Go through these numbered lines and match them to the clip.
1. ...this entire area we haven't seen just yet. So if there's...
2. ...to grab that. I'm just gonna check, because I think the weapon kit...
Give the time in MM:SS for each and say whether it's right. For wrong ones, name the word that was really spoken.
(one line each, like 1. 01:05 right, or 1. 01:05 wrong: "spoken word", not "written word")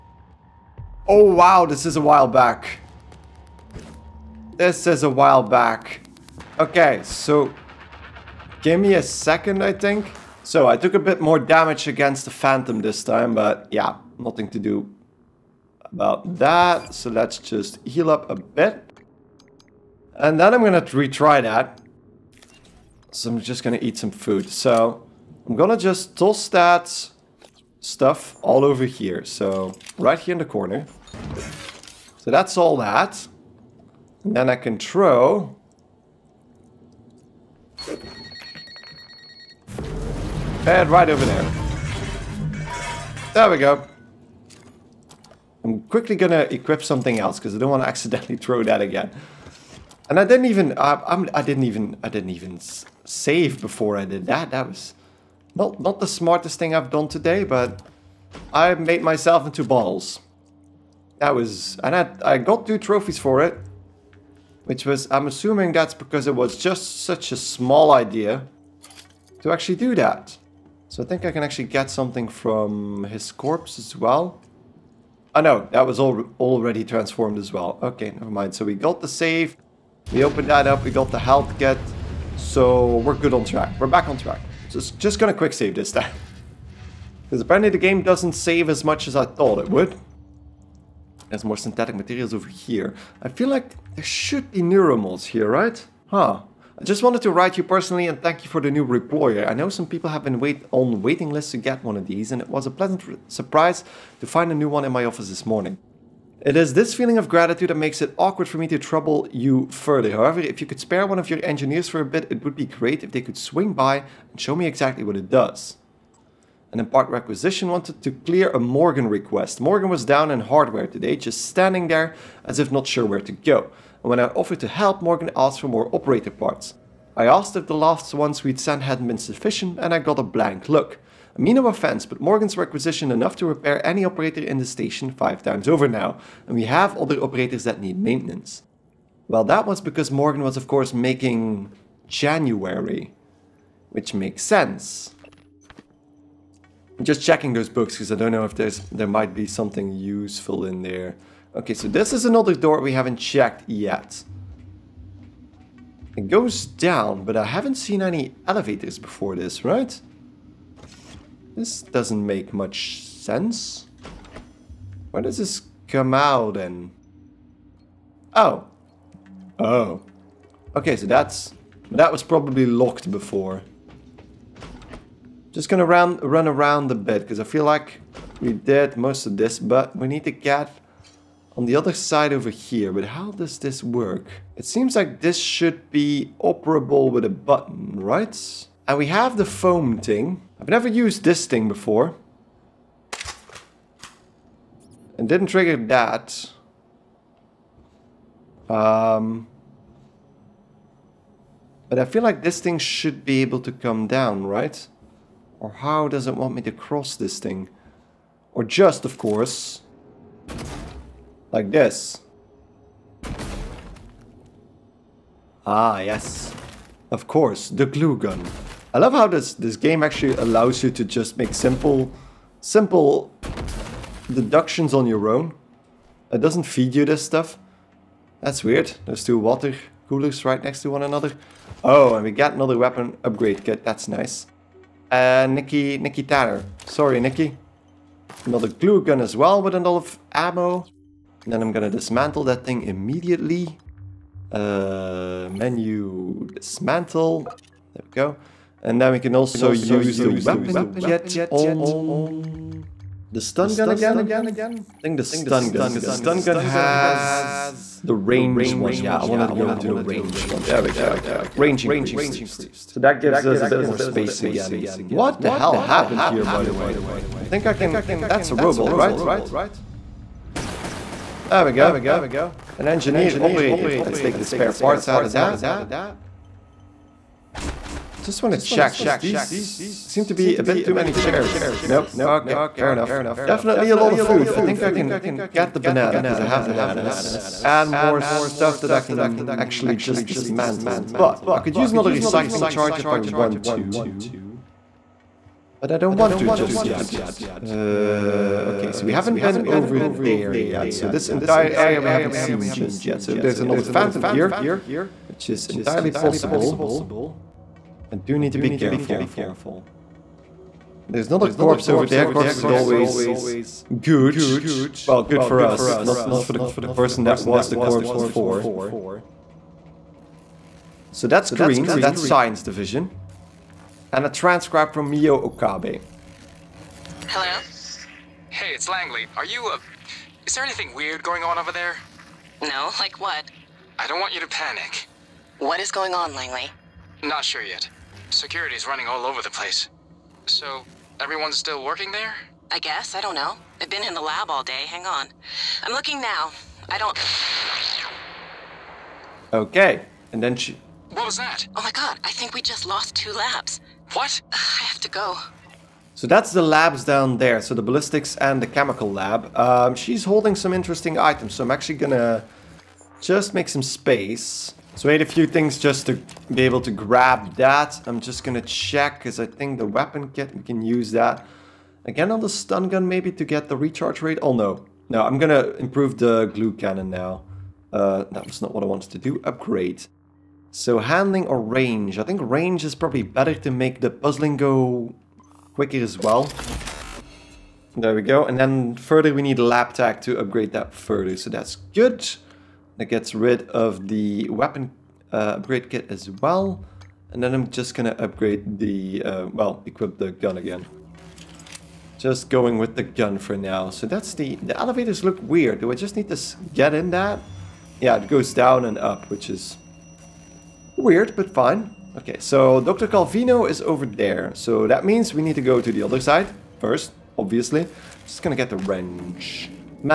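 1. 05:01 right
2. 06:06 right.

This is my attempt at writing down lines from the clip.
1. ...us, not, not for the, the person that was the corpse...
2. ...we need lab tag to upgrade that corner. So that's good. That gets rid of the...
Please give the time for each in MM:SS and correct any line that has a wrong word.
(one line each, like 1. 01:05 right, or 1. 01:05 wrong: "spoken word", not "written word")
1. 05:15 right
2. 06:29 wrong: "further", not "corner".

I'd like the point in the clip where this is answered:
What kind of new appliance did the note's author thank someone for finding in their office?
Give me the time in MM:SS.
01:38.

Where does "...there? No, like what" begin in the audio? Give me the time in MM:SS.
05:31.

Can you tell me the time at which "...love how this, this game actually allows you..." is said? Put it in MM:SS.
03:38.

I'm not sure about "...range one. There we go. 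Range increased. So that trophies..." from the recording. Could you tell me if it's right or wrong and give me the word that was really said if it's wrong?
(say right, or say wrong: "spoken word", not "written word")
wrong: "gives", not "trophies".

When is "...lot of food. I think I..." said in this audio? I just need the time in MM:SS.
04:43.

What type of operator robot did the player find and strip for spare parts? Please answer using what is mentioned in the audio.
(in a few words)
Engineer operator.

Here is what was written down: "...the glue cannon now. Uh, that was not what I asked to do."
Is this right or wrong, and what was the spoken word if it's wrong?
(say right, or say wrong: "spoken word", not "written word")
wrong: "wanted", not "asked".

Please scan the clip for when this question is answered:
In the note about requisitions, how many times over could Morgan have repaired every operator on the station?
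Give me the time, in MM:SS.
02:15.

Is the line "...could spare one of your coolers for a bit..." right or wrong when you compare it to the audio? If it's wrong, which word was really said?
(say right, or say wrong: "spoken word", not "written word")
wrong: "engineers", not "coolers".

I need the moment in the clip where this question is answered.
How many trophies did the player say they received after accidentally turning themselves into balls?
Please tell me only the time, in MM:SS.
01:02.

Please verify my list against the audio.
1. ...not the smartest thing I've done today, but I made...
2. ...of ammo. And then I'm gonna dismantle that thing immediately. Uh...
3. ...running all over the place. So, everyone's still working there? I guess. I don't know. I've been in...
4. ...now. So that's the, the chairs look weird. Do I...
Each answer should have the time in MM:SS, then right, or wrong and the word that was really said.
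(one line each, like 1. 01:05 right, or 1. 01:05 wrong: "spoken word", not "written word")
1. 00:55 right
2. 03:59 right
3. 05:38 right
4. 06:43 wrong: "elevators", not "chairs".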